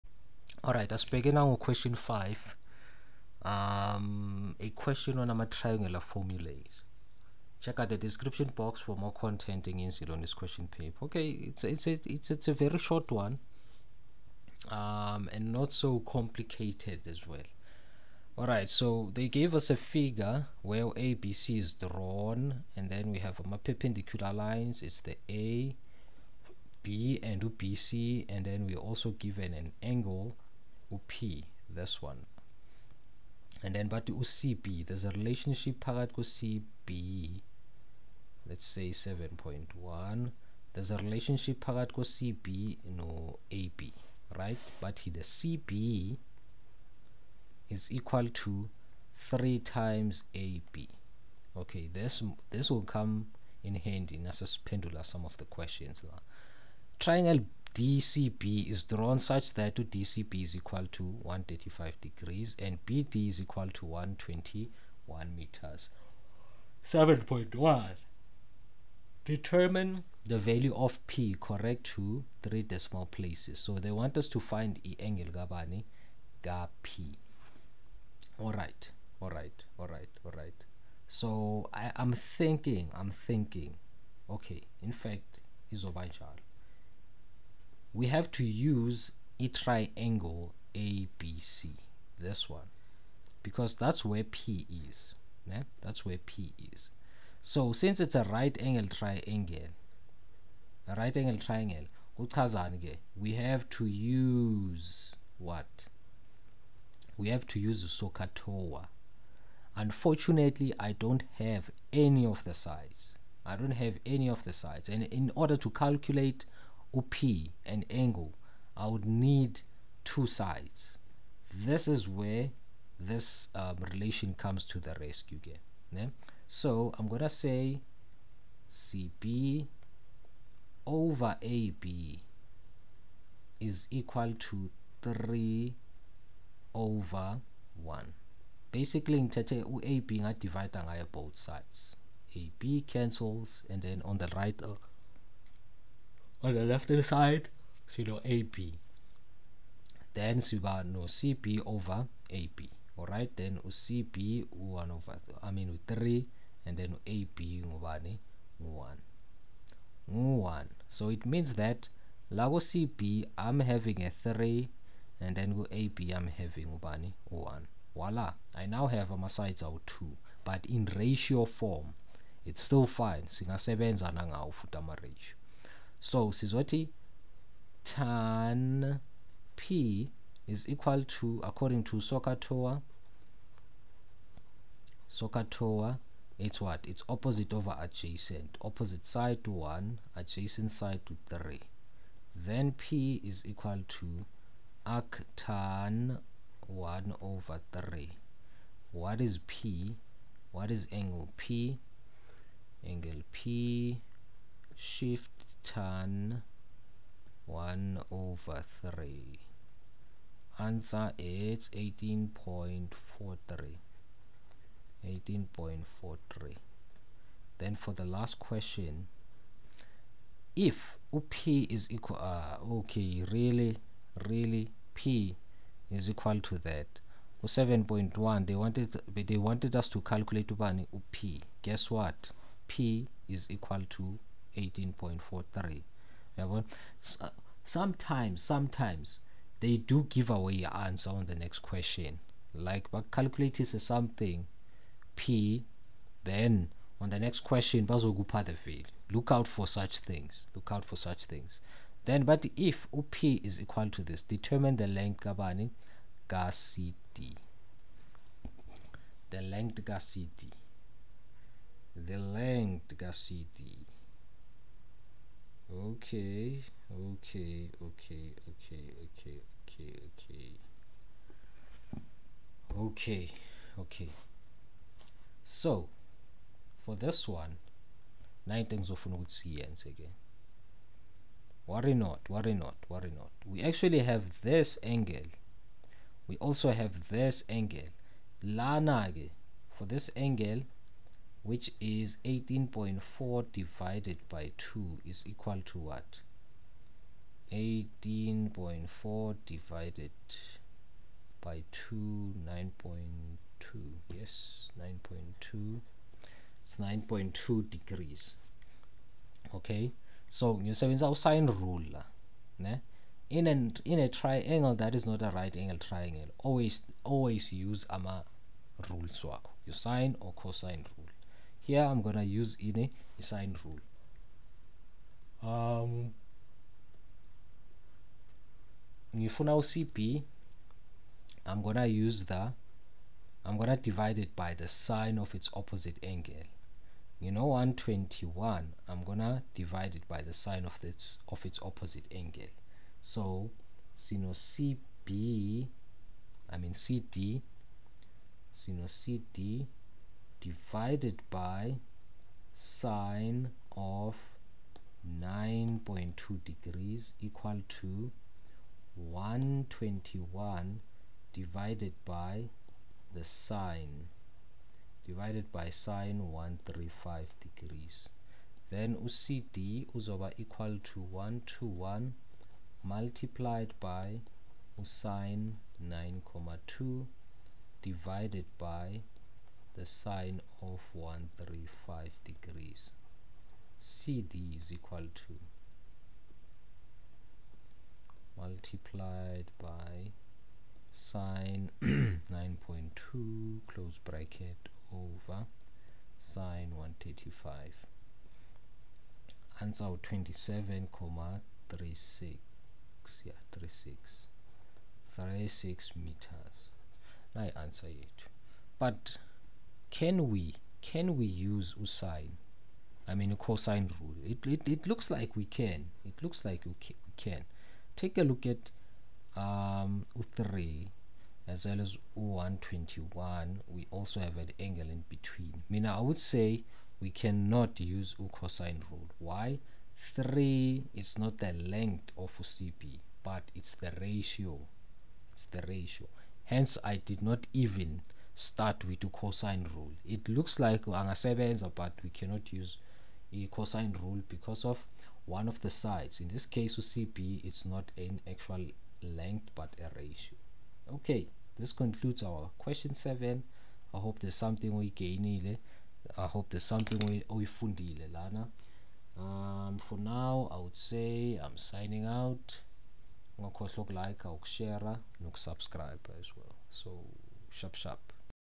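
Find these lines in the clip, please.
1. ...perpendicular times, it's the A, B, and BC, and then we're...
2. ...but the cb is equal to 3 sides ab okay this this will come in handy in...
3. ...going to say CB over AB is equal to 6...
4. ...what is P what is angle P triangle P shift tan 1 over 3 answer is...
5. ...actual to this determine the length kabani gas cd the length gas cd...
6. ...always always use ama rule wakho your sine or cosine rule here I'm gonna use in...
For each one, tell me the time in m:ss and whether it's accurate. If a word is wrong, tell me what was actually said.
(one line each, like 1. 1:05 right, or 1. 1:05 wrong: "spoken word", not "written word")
1. 0:23 wrong: "lines", not "times"
2. 0:44 wrong: "times", not "sides"
3. 2:07 wrong: "3", not "6"
4. 3:18 wrong: "angle", not "triangle"
5. 4:13 wrong: "equal", not "actual"
6. 5:16 right.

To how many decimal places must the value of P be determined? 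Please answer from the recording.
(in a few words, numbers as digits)
three.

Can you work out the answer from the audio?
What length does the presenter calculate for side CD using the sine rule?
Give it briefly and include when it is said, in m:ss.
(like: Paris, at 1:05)
27.36 meters, at 6:40.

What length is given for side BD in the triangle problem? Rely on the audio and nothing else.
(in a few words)
121 meters.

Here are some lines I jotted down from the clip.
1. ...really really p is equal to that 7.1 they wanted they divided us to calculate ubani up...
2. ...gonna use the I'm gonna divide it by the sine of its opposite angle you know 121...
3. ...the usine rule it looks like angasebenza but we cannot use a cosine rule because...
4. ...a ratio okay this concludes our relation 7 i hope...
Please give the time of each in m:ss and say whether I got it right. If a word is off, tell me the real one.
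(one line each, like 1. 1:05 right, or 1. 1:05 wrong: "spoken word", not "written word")
1. 3:43 wrong: "wanted", not "divided"
2. 5:31 right
3. 7:19 wrong: "cosine", not "usine"
4. 7:29 wrong: "question", not "relation".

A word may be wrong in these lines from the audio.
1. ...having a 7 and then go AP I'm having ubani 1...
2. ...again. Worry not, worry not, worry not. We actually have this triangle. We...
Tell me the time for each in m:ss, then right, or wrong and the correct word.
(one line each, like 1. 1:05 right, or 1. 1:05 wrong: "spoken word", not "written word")
1. 2:43 wrong: "3", not "7"
2. 4:39 wrong: "angle", not "triangle".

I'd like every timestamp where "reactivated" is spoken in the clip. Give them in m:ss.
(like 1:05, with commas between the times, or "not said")
not said.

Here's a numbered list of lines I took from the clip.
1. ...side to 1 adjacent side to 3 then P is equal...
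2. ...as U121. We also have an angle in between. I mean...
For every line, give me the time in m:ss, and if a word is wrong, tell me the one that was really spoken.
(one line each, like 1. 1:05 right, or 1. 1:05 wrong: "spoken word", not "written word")
1. 3:09 right
2. 7:01 right.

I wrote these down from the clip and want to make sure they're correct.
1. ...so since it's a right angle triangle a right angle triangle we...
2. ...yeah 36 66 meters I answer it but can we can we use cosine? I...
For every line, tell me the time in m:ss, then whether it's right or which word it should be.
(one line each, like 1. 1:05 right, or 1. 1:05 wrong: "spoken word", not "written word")
1. 1:37 right
2. 6:43 wrong: "36", not "66".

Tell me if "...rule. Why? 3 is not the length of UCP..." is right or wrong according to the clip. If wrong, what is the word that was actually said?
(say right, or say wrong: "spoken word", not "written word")
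right.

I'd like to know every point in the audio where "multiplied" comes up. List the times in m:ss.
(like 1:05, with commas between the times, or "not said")
6:12, 6:28.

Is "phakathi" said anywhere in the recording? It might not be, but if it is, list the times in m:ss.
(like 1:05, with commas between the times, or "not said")
0:35, 0:41.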